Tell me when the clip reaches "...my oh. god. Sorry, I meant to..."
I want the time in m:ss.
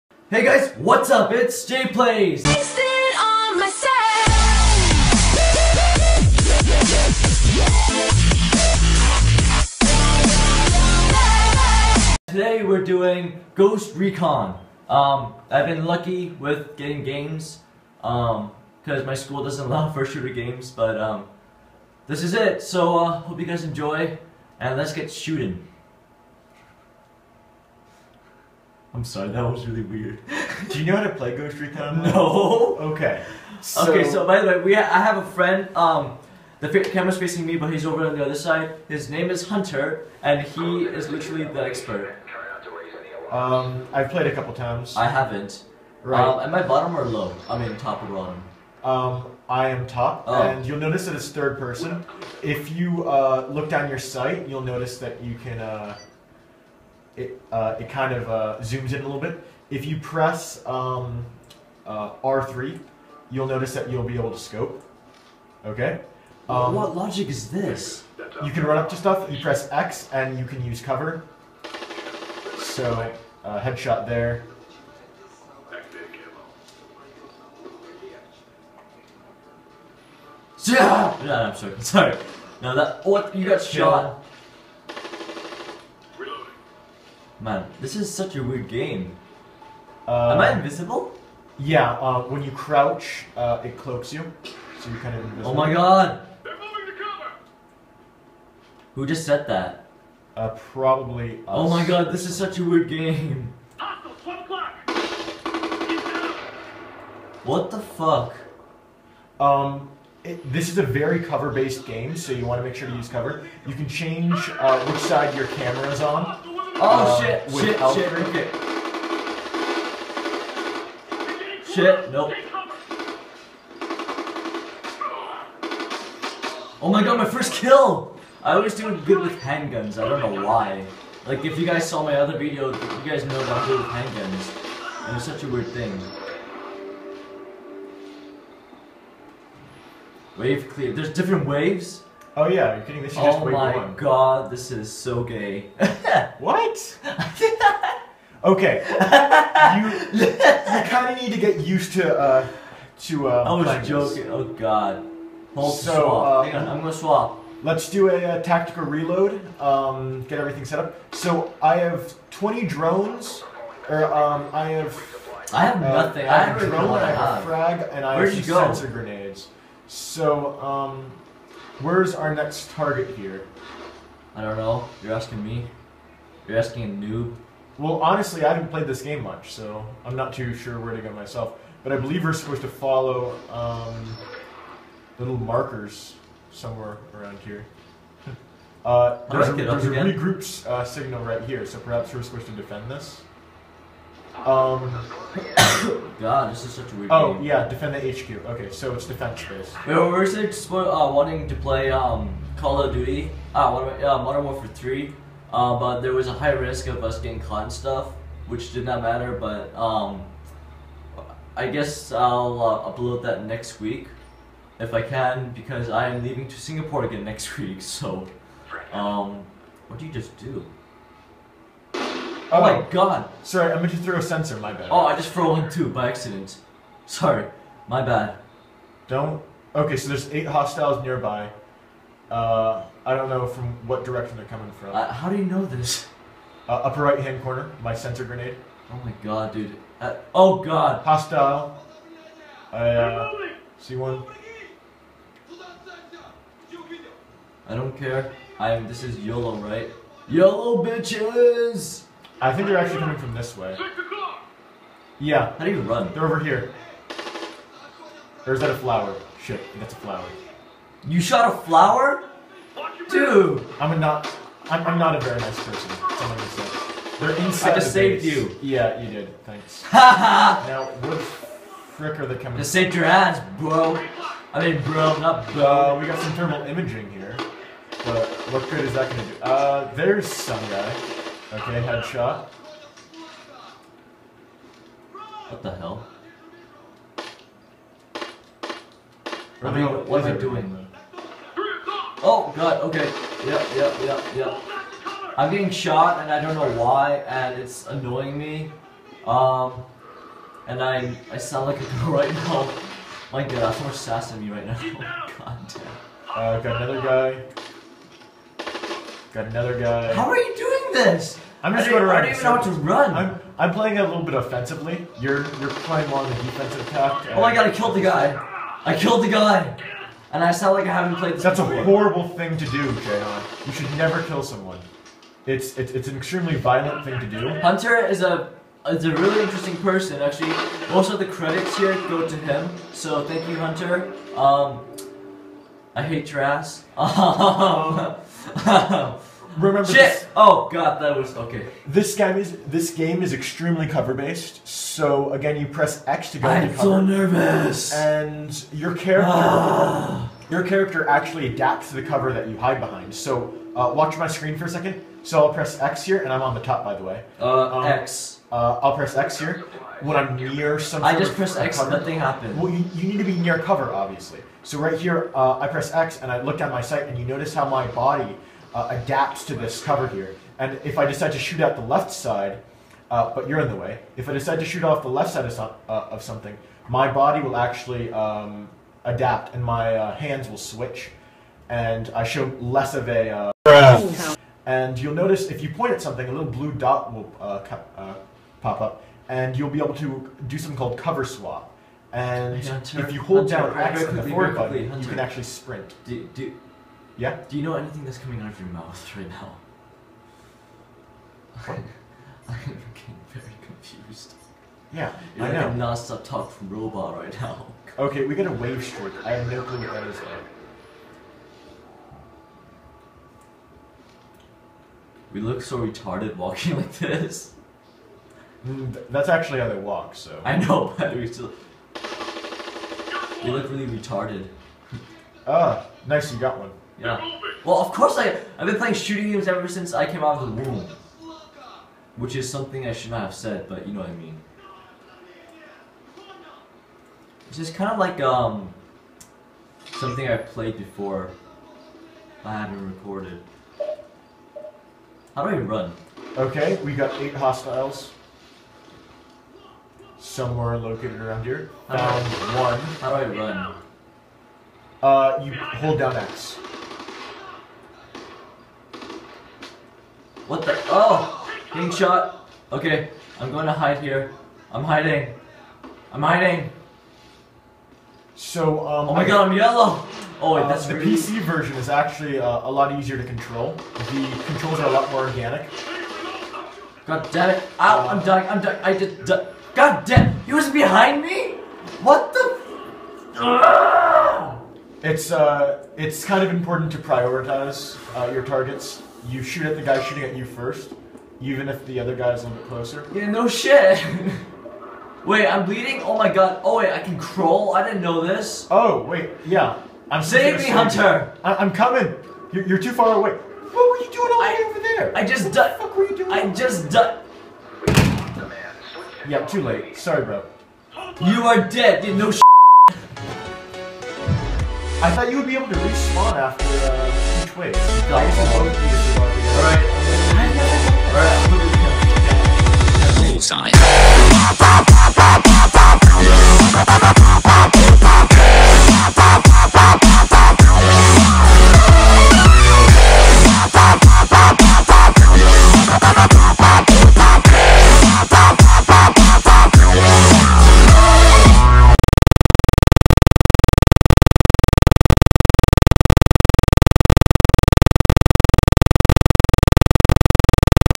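3:42.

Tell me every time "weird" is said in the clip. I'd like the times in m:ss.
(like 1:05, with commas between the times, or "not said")
0:29, 1:28, 1:42, 2:15, 3:16.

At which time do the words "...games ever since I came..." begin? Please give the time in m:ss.
7:09.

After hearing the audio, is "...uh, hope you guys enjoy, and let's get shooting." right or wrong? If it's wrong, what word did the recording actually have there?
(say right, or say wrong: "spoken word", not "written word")
right.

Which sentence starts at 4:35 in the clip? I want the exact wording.
Uh, we got some thermal imaging here.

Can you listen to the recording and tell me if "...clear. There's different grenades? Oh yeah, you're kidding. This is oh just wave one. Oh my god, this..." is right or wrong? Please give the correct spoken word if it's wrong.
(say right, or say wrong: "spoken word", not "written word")
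wrong: "waves", not "grenades".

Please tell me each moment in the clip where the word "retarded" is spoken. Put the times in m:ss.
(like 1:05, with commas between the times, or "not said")
6:55, 7:03.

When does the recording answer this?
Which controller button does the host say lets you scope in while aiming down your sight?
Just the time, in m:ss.
1:02.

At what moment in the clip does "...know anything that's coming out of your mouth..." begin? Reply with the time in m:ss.
6:37.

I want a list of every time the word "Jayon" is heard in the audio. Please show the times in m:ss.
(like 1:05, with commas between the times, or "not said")
5:22.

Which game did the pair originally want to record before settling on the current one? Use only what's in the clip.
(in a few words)
Call of Duty: Modern Warfare 3.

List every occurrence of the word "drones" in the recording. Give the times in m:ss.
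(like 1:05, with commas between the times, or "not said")
2:42, 2:46.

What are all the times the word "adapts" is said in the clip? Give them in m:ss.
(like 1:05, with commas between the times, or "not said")
5:51, 6:09, 6:19.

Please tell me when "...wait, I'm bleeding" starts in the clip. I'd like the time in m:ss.
8:15.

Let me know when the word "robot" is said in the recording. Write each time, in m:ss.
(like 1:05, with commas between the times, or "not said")
6:46.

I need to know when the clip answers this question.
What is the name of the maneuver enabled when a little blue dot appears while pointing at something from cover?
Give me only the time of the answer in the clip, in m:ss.
6:30.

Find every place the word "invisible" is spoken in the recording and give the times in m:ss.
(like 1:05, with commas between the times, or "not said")
1:30, 1:35.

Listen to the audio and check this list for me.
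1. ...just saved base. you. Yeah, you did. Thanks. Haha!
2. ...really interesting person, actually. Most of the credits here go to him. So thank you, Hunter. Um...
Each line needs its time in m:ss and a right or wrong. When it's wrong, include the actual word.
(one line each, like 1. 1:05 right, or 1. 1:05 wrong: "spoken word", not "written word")
1. 4:27 right
2. 5:29 right.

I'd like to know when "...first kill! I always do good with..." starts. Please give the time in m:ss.
2:07.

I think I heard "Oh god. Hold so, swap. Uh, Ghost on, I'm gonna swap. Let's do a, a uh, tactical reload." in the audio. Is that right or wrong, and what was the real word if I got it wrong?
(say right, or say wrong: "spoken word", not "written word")
wrong: "Hang", not "Ghost".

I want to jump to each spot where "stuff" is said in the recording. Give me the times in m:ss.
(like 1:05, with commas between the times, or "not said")
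1:08, 3:27.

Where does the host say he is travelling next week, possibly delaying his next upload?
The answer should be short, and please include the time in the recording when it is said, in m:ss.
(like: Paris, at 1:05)
Singapore, at 3:36.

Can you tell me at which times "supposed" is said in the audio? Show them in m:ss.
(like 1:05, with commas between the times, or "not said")
3:02, 3:12.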